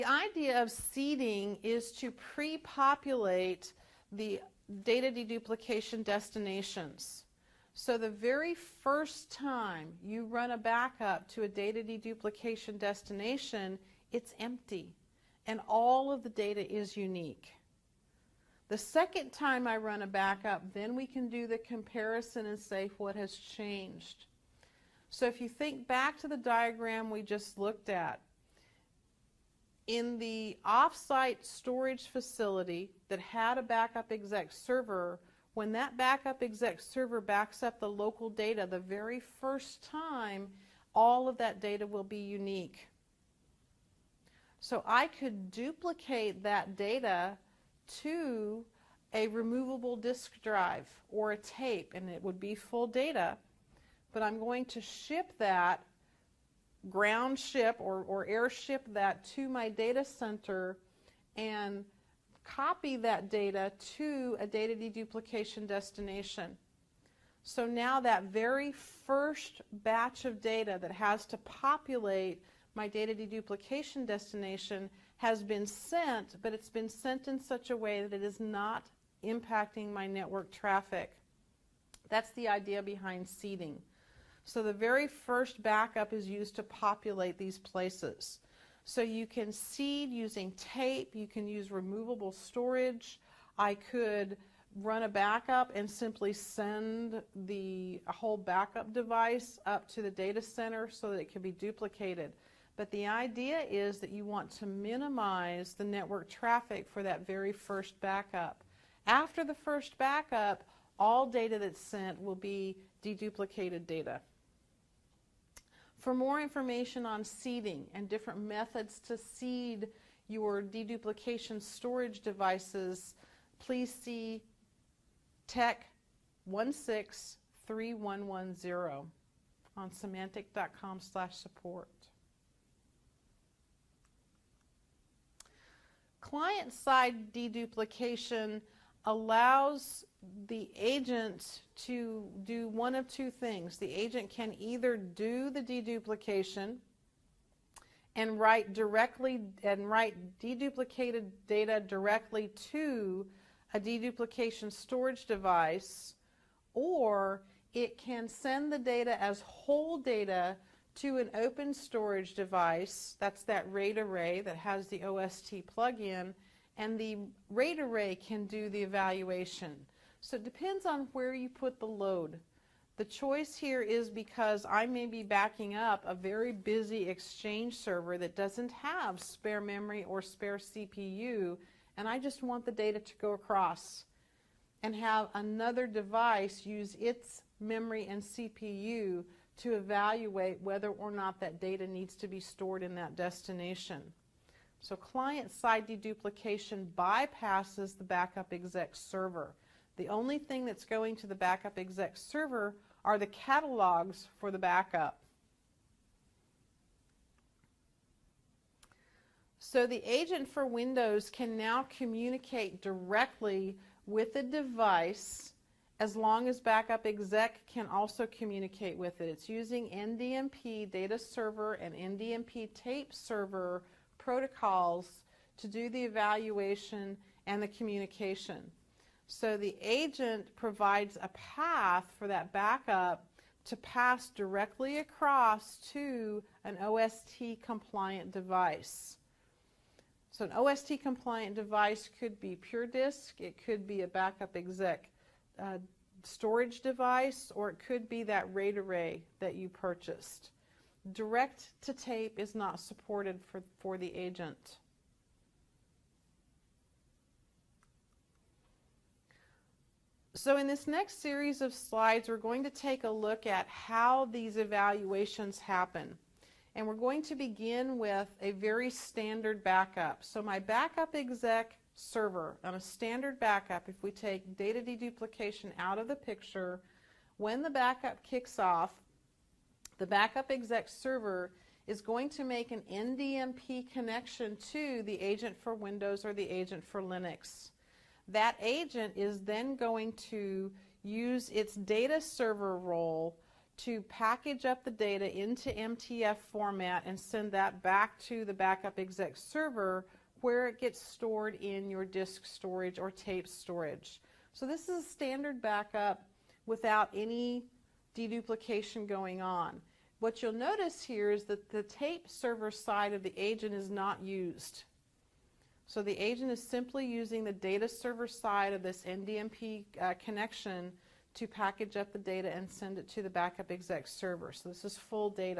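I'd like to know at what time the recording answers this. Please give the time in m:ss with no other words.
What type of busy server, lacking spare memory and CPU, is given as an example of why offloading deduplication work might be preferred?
2:57.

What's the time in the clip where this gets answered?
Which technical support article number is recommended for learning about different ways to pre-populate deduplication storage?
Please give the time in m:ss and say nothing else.
2:05.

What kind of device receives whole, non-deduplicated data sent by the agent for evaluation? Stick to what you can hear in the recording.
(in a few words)
open storage device.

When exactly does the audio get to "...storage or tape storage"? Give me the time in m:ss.
5:02.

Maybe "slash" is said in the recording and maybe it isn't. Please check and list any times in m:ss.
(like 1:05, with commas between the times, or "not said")
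2:10.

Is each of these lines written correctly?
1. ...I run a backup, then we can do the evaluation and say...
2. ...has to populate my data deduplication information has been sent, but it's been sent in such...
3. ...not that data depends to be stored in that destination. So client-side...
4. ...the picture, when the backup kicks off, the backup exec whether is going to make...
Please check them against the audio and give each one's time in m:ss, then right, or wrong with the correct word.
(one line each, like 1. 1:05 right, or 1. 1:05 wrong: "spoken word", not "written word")
1. 0:19 wrong: "comparison", not "evaluation"
2. 1:10 wrong: "destination", not "information"
3. 3:11 wrong: "needs", not "depends"
4. 4:36 wrong: "server", not "whether".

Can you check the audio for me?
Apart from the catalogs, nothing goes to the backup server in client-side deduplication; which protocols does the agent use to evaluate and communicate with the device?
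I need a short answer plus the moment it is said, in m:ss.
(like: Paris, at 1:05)
NDMP data server and NDMP tape server, at 3:39.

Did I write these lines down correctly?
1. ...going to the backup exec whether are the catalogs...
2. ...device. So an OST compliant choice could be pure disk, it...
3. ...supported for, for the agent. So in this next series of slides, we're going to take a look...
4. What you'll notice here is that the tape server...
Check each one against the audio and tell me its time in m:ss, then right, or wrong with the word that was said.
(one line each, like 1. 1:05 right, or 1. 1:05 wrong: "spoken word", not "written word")
1. 3:20 wrong: "server", not "whether"
2. 3:58 wrong: "device", not "choice"
3. 4:12 right
4. 5:10 right.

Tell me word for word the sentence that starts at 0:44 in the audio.
So I could duplicate that data to a removable disk drive or a tape, and it would be full data.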